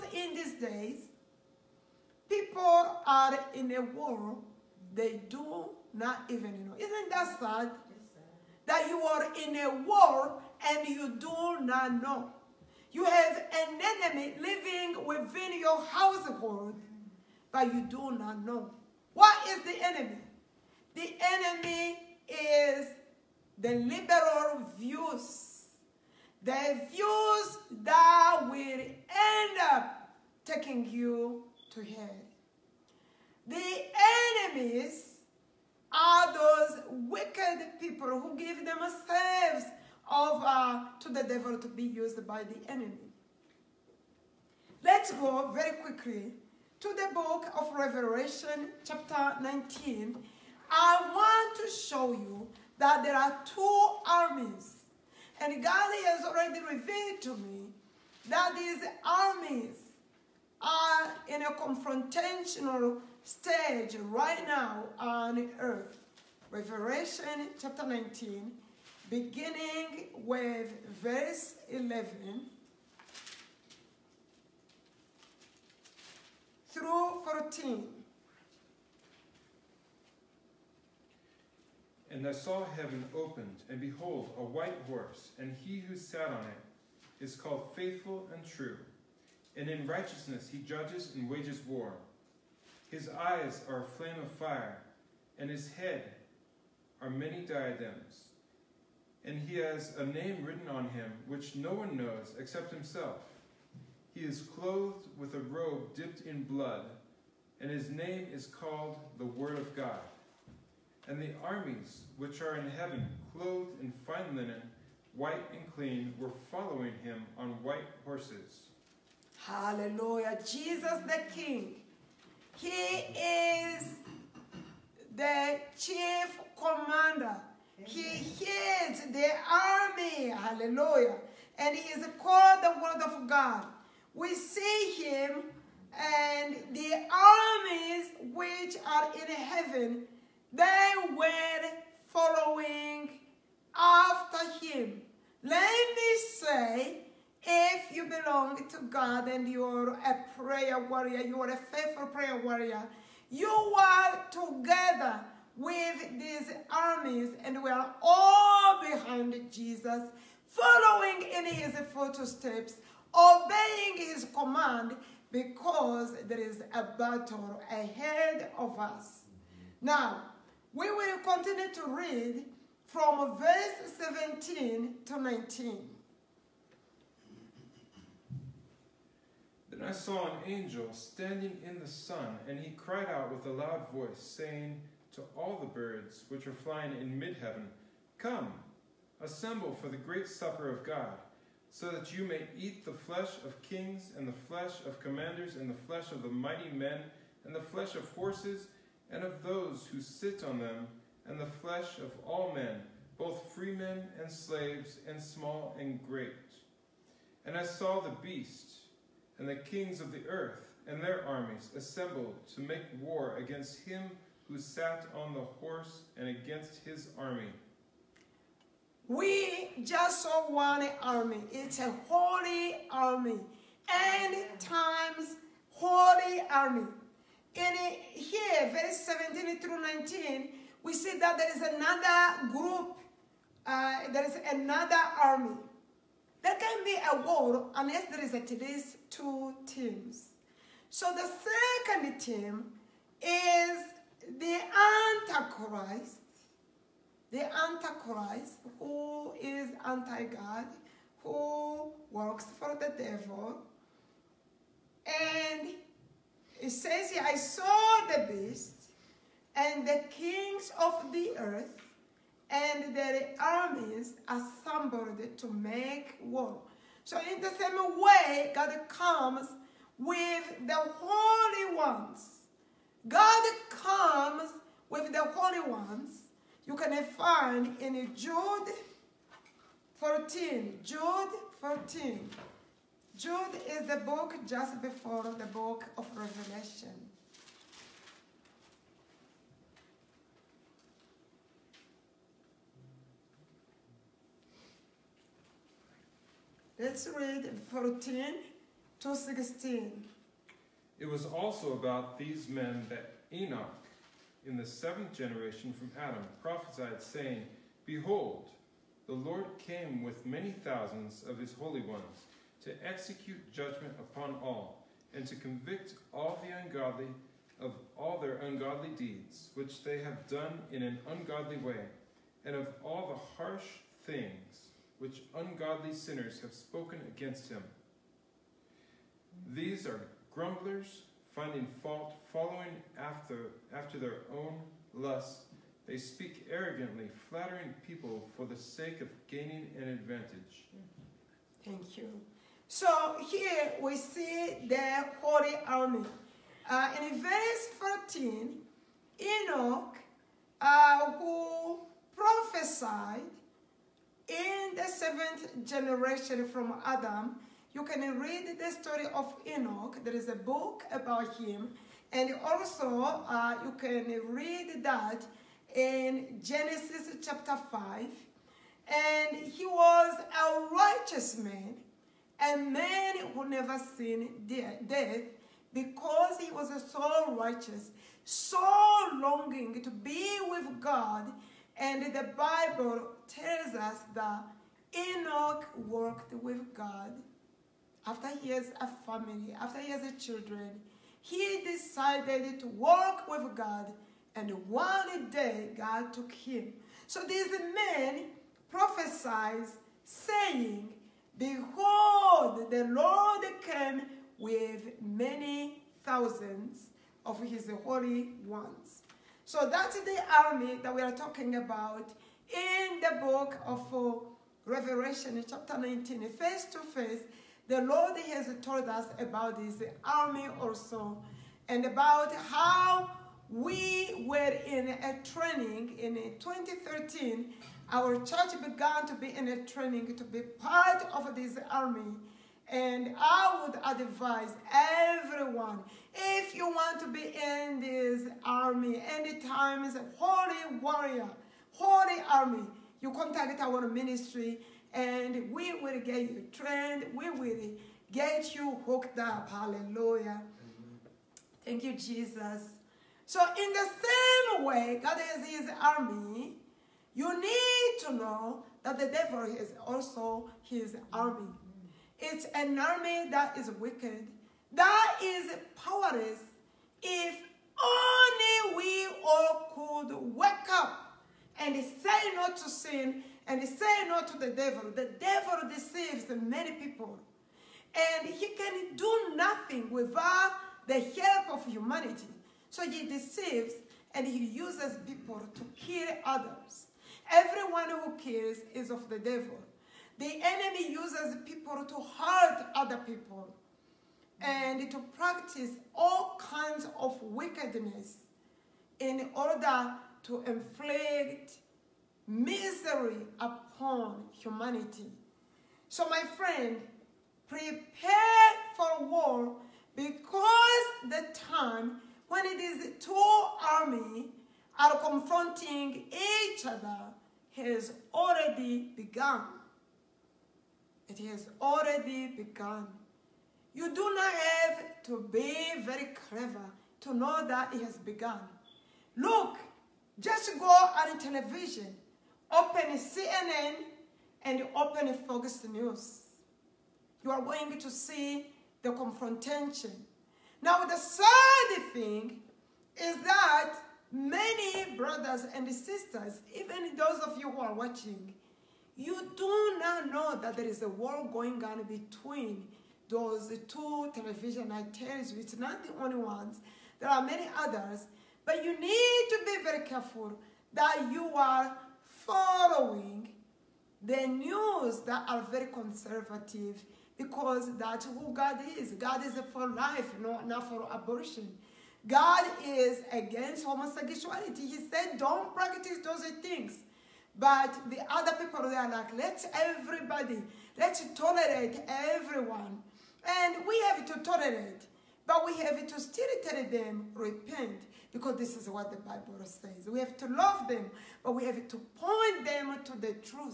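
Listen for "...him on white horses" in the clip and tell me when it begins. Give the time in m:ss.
1:57.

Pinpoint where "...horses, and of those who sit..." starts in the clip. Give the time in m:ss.
3:18.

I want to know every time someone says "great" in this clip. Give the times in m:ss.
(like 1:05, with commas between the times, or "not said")
3:09, 3:26.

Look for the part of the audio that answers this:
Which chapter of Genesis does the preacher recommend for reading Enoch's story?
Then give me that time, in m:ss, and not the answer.
6:06.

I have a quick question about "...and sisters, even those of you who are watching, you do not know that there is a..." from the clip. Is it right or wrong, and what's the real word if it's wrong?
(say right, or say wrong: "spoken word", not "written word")
right.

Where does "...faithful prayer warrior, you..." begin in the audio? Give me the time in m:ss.
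2:31.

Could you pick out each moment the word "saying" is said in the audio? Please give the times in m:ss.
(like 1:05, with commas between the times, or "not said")
3:04, 5:07, 6:40.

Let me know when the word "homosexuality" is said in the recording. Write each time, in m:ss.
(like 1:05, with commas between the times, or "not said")
9:33.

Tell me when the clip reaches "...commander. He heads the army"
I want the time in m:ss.
2:06.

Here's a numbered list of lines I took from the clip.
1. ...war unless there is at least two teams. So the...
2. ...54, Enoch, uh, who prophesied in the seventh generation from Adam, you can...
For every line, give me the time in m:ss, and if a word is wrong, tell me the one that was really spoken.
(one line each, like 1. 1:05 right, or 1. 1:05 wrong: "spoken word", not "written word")
1. 3:57 right
2. 5:48 wrong: "14", not "54".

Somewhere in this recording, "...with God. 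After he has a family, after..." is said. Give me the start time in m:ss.
6:26.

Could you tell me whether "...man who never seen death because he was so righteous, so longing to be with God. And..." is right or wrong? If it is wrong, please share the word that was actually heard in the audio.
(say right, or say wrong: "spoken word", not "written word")
right.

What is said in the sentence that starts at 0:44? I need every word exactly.
Let's go very quickly to the book of Revelation, chapter 19, I want to show you that there are two armies.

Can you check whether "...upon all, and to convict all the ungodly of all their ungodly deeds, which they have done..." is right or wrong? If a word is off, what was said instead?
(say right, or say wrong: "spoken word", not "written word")
right.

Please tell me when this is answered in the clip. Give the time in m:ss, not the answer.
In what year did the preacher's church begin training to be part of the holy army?
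7:06.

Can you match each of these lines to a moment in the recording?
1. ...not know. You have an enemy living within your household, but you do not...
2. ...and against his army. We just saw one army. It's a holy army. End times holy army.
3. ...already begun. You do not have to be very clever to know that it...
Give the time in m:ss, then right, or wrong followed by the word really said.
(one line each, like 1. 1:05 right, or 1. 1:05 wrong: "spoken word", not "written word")
1. 0:11 right
2. 3:36 right
3. 8:41 right.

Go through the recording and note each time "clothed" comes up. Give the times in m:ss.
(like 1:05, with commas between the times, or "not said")
1:44, 1:53.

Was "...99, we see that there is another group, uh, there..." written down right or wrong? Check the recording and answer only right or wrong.
wrong.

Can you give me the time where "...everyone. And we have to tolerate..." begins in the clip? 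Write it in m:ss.
9:41.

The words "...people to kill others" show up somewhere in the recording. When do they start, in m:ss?
8:05.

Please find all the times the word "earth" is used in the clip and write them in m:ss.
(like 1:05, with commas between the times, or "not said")
1:05, 3:30, 4:21.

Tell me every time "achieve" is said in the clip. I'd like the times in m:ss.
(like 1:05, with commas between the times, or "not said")
not said.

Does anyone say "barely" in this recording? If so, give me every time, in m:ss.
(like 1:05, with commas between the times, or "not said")
not said.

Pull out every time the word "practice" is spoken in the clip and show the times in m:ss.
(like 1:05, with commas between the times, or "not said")
8:15, 9:35.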